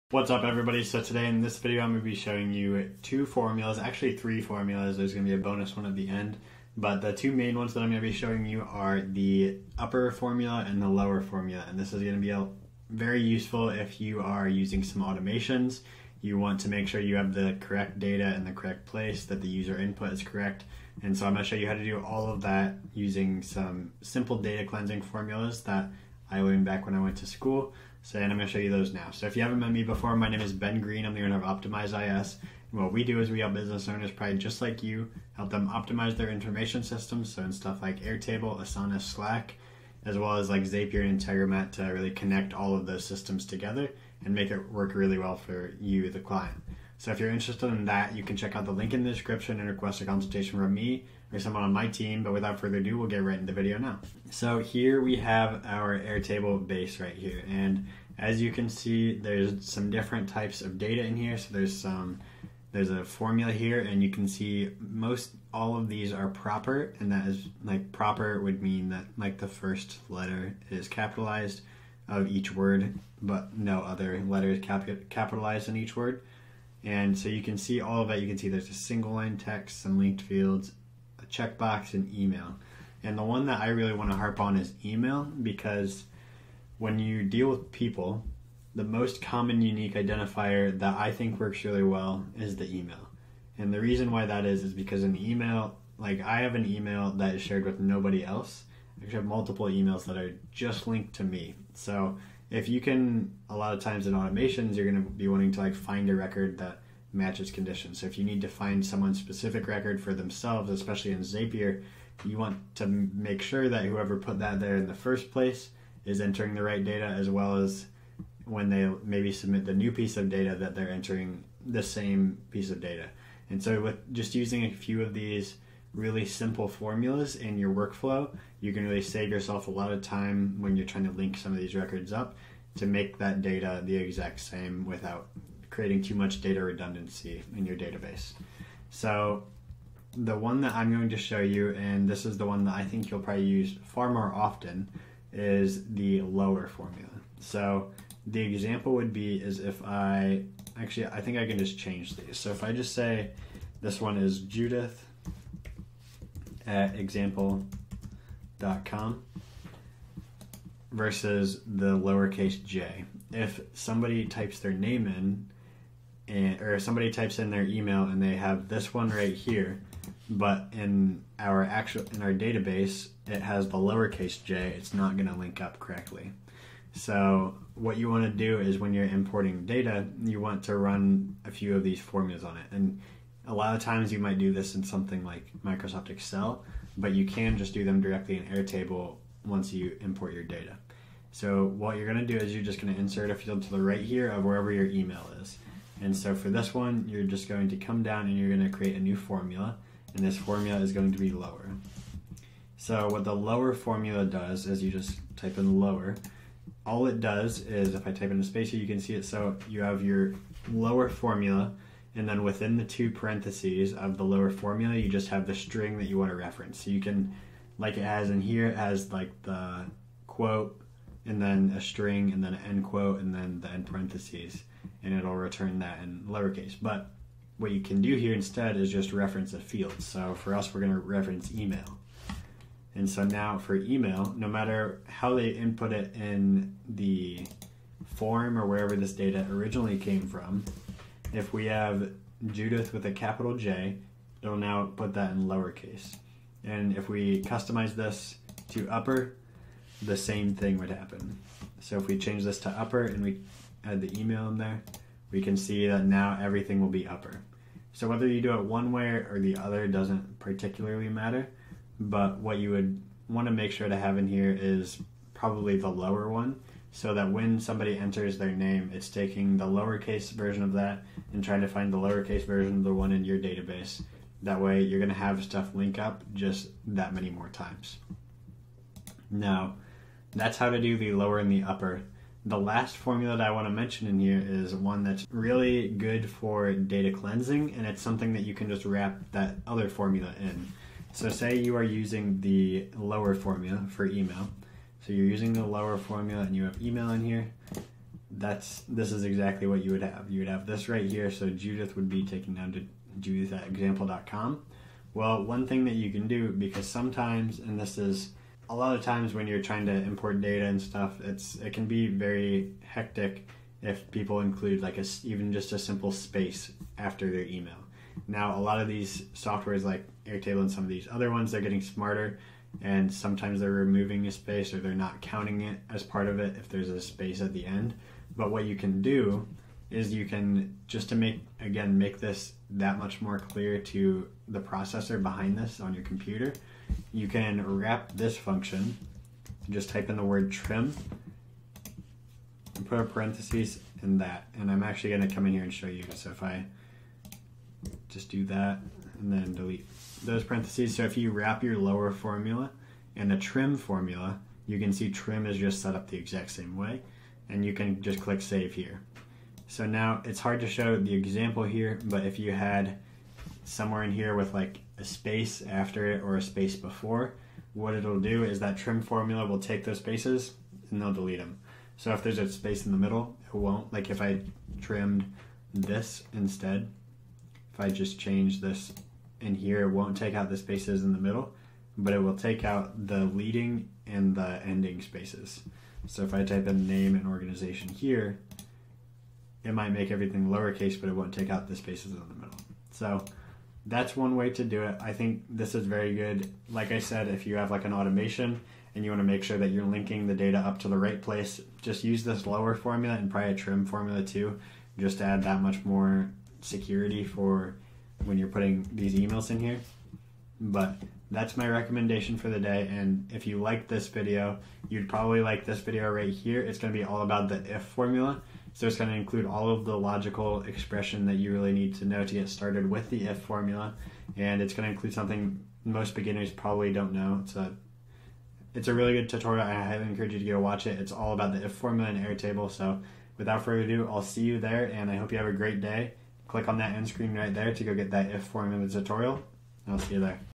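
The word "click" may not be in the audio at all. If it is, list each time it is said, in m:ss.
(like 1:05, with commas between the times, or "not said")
5:58, 7:16.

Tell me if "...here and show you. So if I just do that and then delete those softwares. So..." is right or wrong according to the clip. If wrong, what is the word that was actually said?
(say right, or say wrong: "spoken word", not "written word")
wrong: "parentheses", not "softwares".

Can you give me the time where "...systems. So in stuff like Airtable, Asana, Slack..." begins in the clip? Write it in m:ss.
0:36.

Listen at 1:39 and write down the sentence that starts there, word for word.
I have multiple emails that are just linked to me.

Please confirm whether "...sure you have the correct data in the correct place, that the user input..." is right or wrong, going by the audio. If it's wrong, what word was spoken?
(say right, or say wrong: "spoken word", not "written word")
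right.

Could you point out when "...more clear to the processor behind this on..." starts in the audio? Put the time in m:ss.
5:33.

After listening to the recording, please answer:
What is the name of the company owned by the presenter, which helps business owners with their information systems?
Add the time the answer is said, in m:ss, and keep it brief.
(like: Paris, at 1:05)
Optimize IS, at 0:31.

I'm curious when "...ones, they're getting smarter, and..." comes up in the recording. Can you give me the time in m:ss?
5:21.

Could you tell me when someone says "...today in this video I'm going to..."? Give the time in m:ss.
0:01.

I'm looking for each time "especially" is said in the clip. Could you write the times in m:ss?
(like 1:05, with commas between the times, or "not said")
1:50.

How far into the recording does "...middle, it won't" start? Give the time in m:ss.
6:12.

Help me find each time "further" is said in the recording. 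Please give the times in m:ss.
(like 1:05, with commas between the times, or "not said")
0:52, 7:13.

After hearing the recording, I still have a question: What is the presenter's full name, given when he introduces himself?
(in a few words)
Ben Green.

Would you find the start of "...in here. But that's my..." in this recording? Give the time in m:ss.
6:49.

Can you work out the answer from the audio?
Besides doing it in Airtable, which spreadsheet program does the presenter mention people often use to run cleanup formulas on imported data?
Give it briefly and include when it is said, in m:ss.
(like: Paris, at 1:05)
Microsoft Excel, at 3:05.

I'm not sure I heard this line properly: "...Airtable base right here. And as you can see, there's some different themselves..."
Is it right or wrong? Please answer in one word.
wrong.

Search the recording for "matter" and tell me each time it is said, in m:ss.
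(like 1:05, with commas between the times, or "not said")
3:54, 4:21.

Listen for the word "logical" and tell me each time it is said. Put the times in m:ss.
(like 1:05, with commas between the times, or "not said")
6:59.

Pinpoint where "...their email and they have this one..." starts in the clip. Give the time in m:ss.
2:47.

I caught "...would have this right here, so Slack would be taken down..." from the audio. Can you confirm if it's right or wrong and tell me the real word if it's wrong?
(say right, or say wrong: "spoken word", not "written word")
wrong: "Judith", not "Slack".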